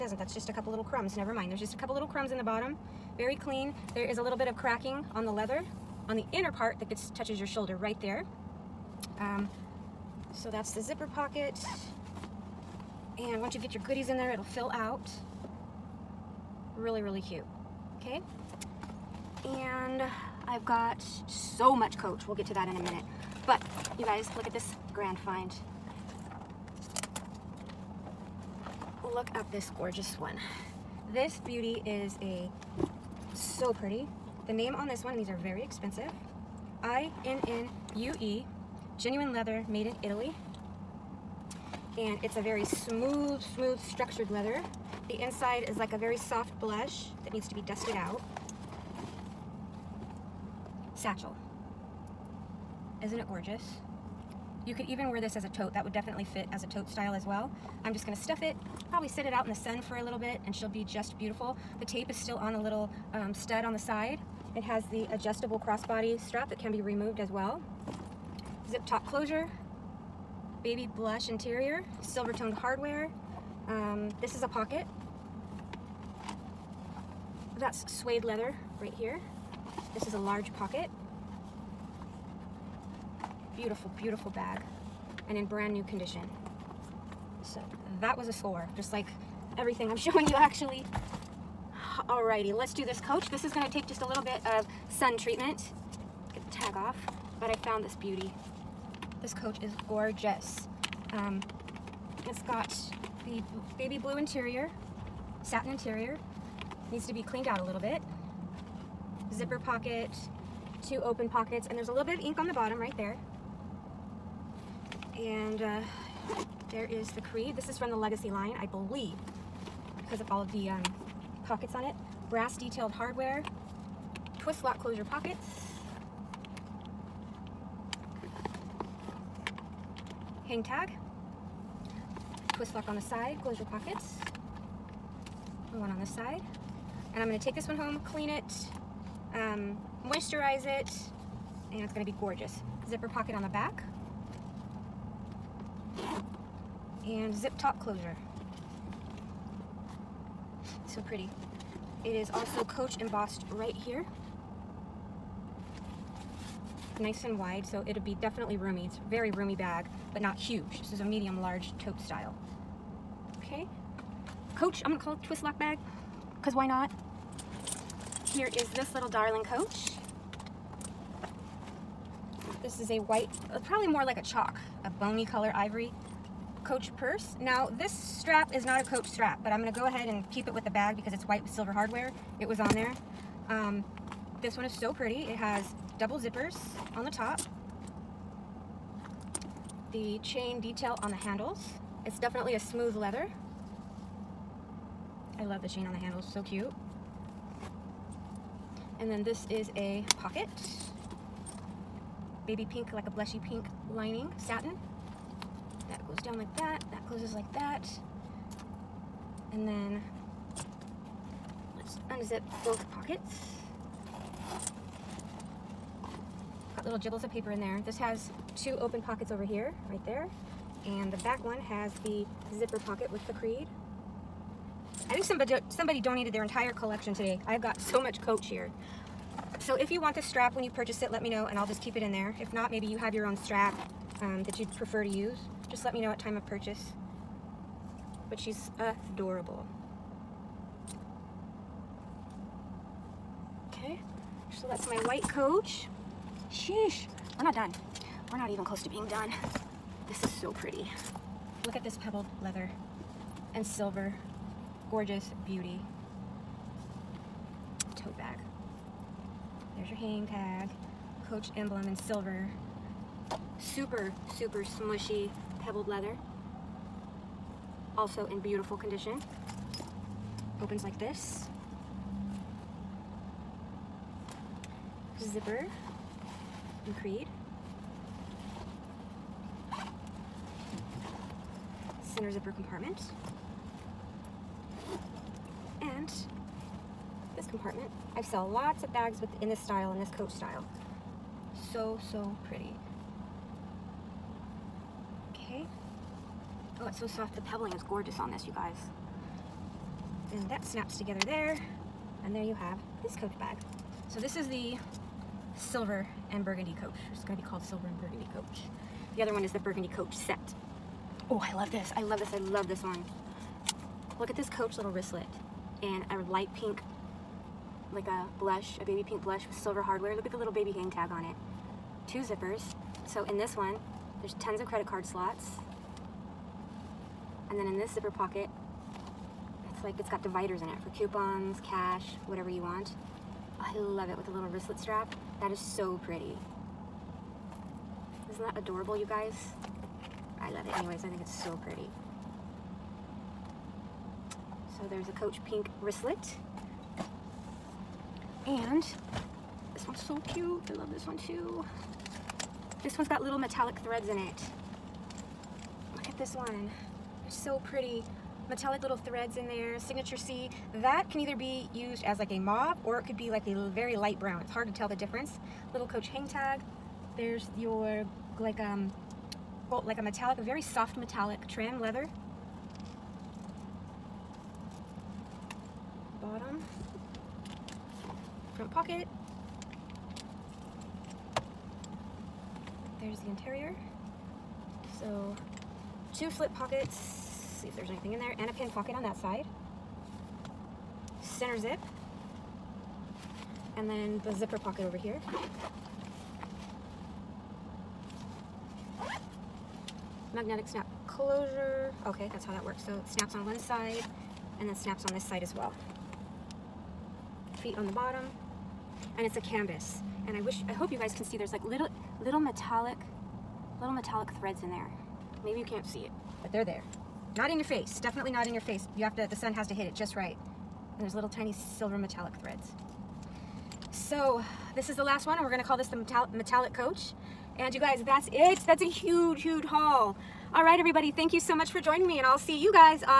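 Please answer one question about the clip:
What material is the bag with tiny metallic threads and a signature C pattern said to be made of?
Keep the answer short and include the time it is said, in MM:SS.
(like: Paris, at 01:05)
canvas, at 06:49.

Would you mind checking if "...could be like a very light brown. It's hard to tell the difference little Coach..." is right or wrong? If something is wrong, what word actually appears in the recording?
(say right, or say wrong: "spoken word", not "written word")
right.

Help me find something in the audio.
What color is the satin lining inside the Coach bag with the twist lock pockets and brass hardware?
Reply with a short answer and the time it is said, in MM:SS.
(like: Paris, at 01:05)
baby blue, at 01:43.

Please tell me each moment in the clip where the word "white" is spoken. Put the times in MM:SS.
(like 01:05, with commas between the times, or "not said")
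02:52, 03:01, 04:05.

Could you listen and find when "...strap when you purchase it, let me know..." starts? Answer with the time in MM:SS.
03:50.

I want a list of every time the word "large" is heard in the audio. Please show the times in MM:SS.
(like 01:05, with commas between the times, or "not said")
01:20, 02:41.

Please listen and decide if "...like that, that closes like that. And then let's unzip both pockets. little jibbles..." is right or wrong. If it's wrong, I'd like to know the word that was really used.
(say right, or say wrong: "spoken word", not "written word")
right.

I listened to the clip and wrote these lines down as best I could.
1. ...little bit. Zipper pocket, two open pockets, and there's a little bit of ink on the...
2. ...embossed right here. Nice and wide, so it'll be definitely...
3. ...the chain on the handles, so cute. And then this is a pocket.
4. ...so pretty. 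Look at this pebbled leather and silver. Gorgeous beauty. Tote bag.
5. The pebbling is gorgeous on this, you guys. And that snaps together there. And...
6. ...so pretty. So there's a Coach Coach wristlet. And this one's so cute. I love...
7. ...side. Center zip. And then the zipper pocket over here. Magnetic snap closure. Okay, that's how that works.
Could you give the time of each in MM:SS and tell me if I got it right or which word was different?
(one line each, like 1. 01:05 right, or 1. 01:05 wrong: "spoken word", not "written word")
1. 01:47 right
2. 02:32 right
3. 03:15 right
4. 04:10 right
5. 04:57 right
6. 05:41 wrong: "Pink", not "Coach"
7. 06:29 right.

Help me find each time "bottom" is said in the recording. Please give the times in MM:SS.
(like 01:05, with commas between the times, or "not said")
00:02, 01:52, 06:16, 06:47.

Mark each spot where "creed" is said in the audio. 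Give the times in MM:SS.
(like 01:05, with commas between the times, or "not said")
01:57, 03:43, 04:37.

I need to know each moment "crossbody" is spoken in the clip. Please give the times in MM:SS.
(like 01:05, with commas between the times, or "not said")
01:05.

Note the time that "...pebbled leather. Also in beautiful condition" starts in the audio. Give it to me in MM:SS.
04:25.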